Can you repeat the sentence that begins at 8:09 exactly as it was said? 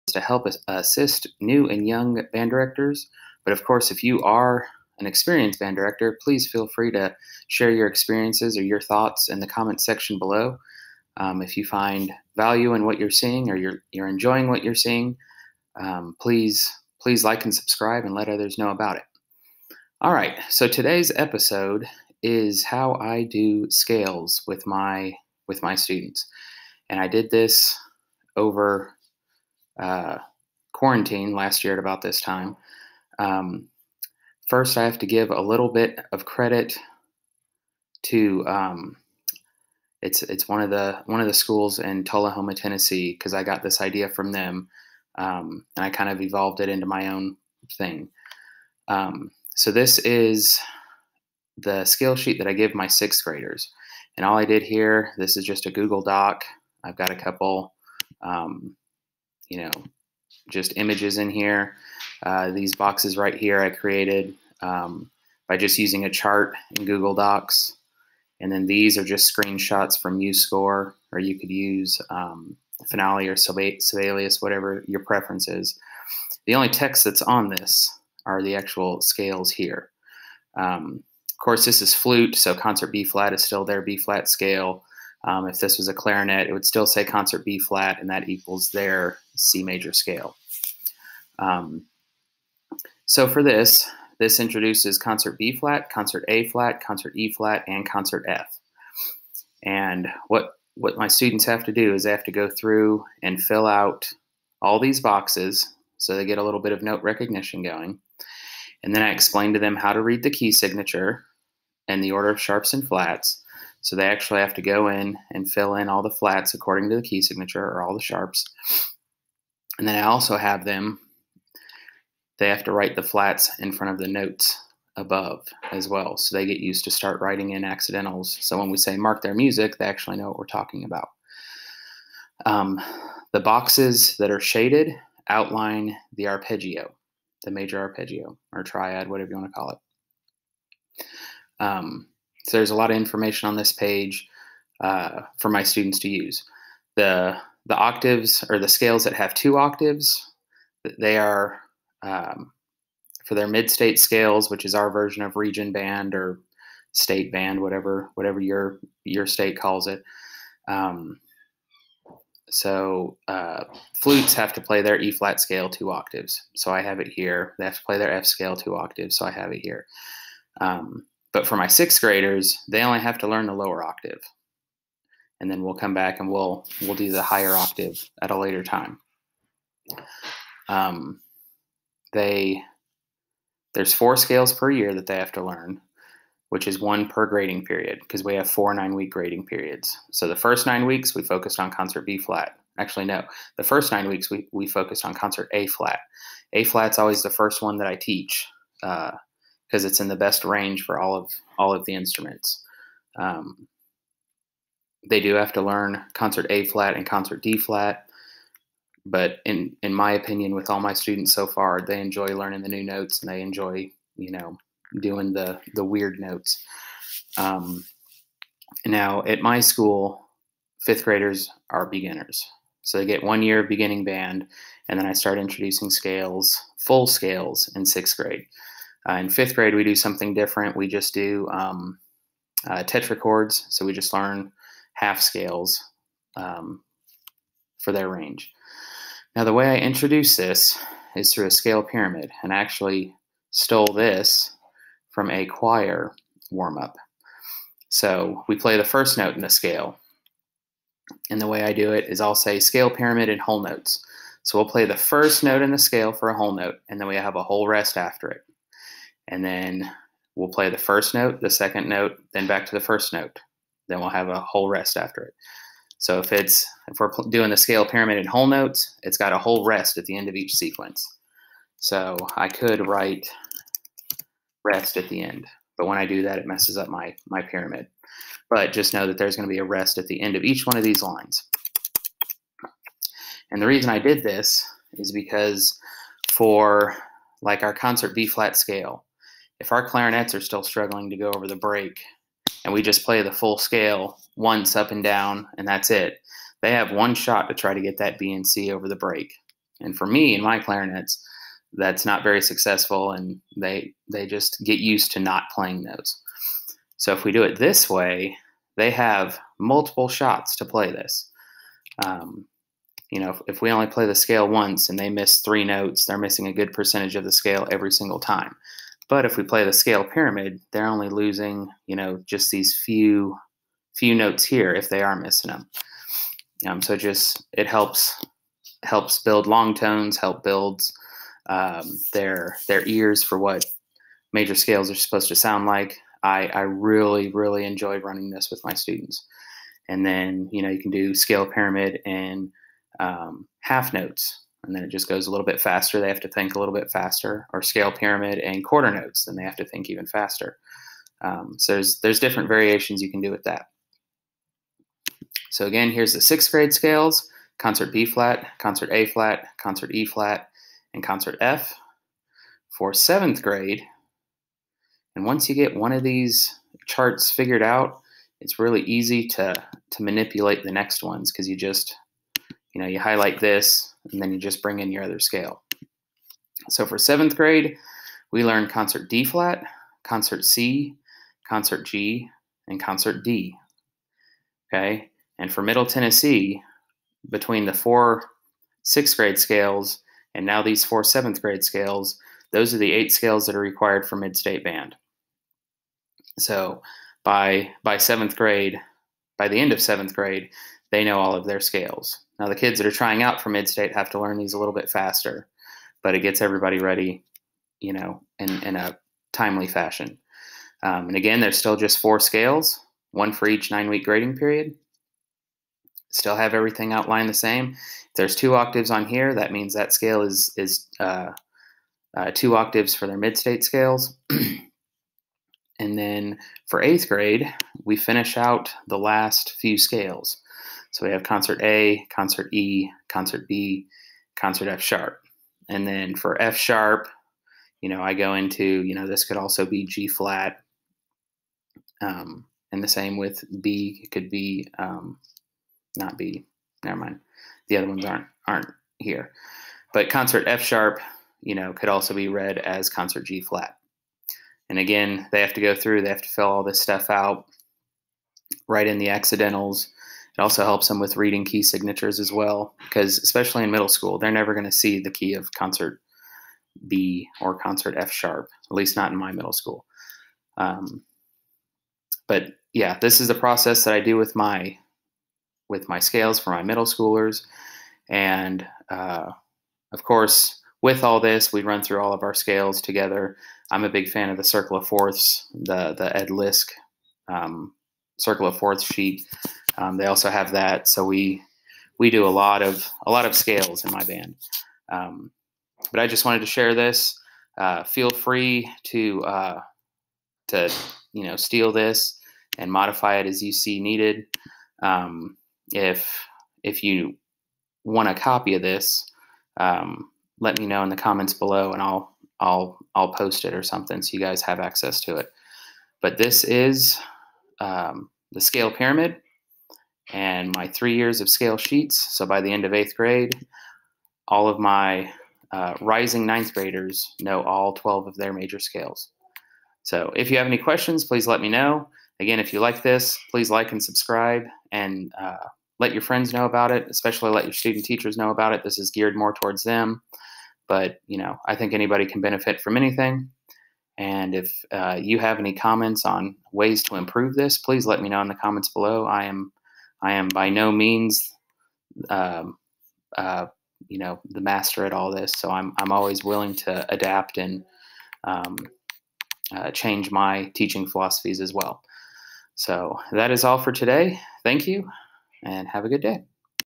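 Um, they also have that, so we we do a lot of a lot of scales in my band.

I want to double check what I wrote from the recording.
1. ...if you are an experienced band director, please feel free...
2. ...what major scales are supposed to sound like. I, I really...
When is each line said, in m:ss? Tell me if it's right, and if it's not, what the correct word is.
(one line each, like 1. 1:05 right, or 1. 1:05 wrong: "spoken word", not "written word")
1. 0:03 right
2. 5:33 right.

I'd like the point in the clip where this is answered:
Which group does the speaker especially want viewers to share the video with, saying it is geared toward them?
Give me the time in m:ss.
8:57.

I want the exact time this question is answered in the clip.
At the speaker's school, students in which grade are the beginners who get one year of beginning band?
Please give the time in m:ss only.
3:40.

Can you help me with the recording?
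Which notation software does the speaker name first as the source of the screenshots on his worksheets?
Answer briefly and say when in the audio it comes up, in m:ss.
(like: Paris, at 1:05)
MuseScore, at 1:10.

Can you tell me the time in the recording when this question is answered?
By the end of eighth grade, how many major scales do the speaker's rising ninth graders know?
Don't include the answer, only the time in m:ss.
8:47.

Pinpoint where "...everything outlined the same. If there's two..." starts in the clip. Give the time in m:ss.
6:56.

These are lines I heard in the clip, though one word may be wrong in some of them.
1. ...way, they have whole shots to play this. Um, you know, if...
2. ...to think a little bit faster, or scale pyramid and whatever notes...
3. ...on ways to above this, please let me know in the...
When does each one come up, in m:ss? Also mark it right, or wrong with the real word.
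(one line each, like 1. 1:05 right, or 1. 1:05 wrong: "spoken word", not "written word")
1. 5:07 wrong: "multiple", not "whole"
2. 5:46 wrong: "quarter", not "whatever"
3. 9:06 wrong: "improve", not "above".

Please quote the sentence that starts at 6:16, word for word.
So for seventh grade, we learned concert D flat, concert C, concert G, and concert D.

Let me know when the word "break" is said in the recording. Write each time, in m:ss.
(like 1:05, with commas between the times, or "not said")
4:51, 4:58.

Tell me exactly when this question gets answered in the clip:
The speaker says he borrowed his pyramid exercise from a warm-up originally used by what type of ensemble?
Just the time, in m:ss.
4:05.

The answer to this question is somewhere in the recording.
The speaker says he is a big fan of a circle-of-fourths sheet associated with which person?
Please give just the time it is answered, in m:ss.
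8:06.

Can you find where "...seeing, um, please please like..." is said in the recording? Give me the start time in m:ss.
0:14.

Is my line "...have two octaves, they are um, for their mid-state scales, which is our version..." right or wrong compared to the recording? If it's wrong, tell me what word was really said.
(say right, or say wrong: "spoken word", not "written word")
right.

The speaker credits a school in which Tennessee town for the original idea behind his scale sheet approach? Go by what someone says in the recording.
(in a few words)
Tullahoma.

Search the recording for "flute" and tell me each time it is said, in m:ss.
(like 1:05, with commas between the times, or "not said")
1:21, 2:44.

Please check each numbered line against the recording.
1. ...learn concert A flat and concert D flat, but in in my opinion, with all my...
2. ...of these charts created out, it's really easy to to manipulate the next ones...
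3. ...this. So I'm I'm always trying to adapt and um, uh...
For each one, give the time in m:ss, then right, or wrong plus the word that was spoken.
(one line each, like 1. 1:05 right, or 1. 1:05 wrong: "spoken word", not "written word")
1. 3:25 right
2. 6:05 wrong: "figured", not "created"
3. 9:15 wrong: "willing", not "trying".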